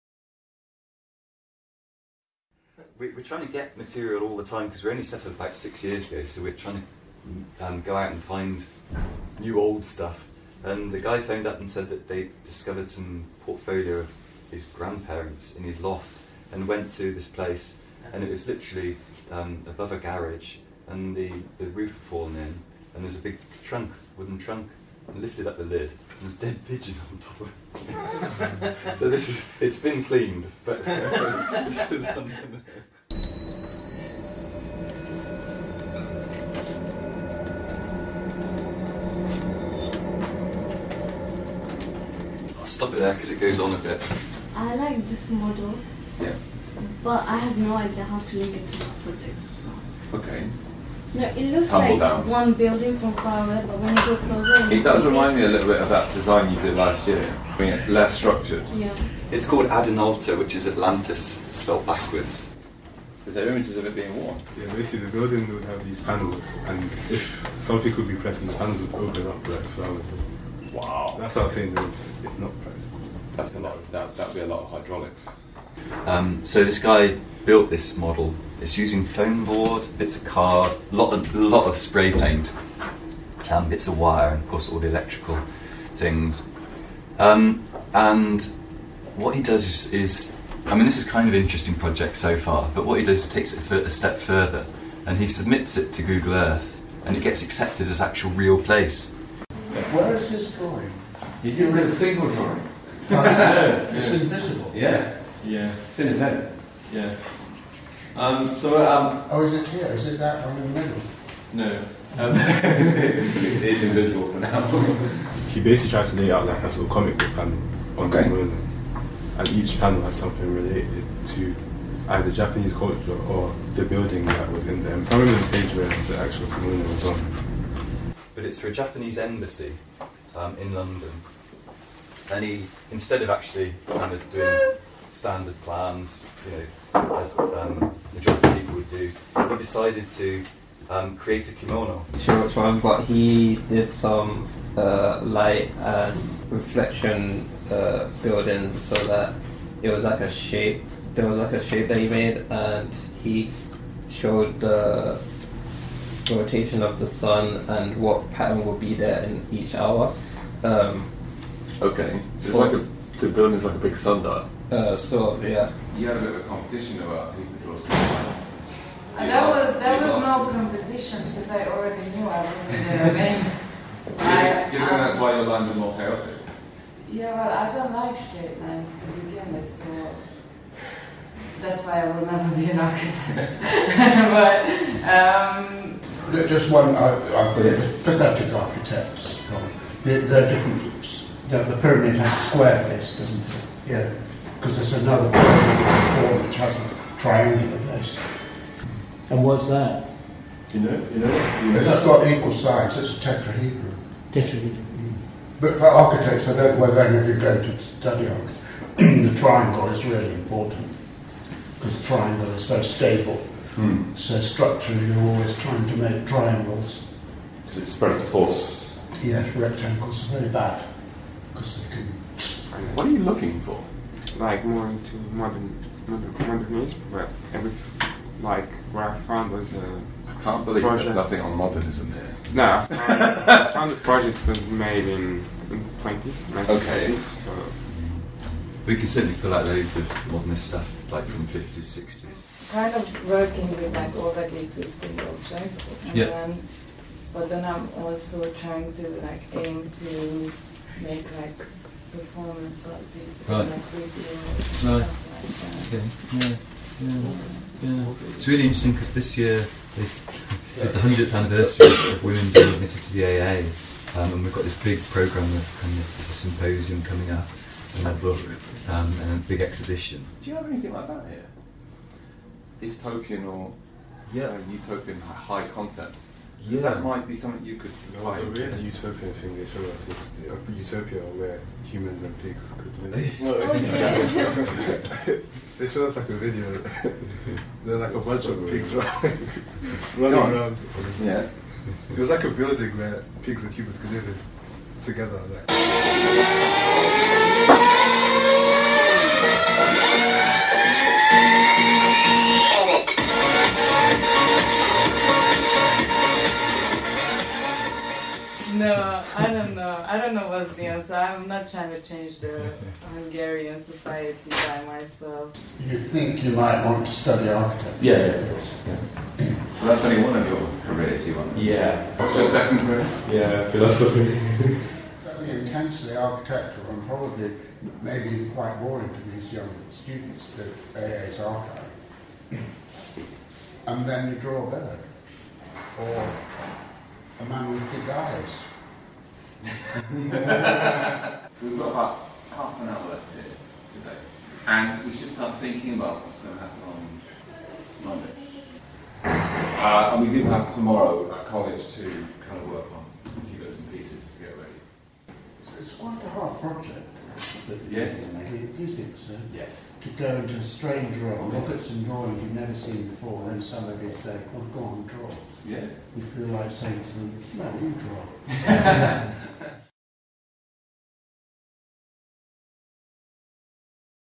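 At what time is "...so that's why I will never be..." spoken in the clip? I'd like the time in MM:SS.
02:59.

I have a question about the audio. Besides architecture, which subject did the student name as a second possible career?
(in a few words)
philosophy.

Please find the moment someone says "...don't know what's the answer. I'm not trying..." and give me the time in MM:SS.
05:10.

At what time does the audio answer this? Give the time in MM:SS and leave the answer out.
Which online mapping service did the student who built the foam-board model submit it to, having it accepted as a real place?
01:36.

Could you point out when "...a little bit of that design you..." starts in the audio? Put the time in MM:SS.
00:55.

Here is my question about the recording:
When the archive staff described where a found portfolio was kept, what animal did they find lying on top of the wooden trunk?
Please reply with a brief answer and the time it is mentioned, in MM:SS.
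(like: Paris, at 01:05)
dead pigeon, at 00:26.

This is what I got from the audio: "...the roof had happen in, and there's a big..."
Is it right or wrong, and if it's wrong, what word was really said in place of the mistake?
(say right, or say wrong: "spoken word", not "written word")
wrong: "fallen", not "happen".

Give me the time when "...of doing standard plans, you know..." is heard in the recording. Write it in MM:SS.
02:14.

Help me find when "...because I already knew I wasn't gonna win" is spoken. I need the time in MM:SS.
02:51.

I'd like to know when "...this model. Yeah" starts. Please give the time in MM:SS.
00:45.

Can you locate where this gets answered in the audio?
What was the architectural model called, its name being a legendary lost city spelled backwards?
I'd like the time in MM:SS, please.
00:59.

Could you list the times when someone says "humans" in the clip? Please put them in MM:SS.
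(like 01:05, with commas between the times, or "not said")
04:41, 04:53.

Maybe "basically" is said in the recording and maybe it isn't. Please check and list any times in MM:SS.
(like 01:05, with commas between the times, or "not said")
01:04, 01:55.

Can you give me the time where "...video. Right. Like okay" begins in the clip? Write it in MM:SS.
04:13.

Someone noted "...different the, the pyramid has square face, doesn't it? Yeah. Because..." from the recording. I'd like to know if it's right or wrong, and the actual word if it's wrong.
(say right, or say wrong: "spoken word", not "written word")
right.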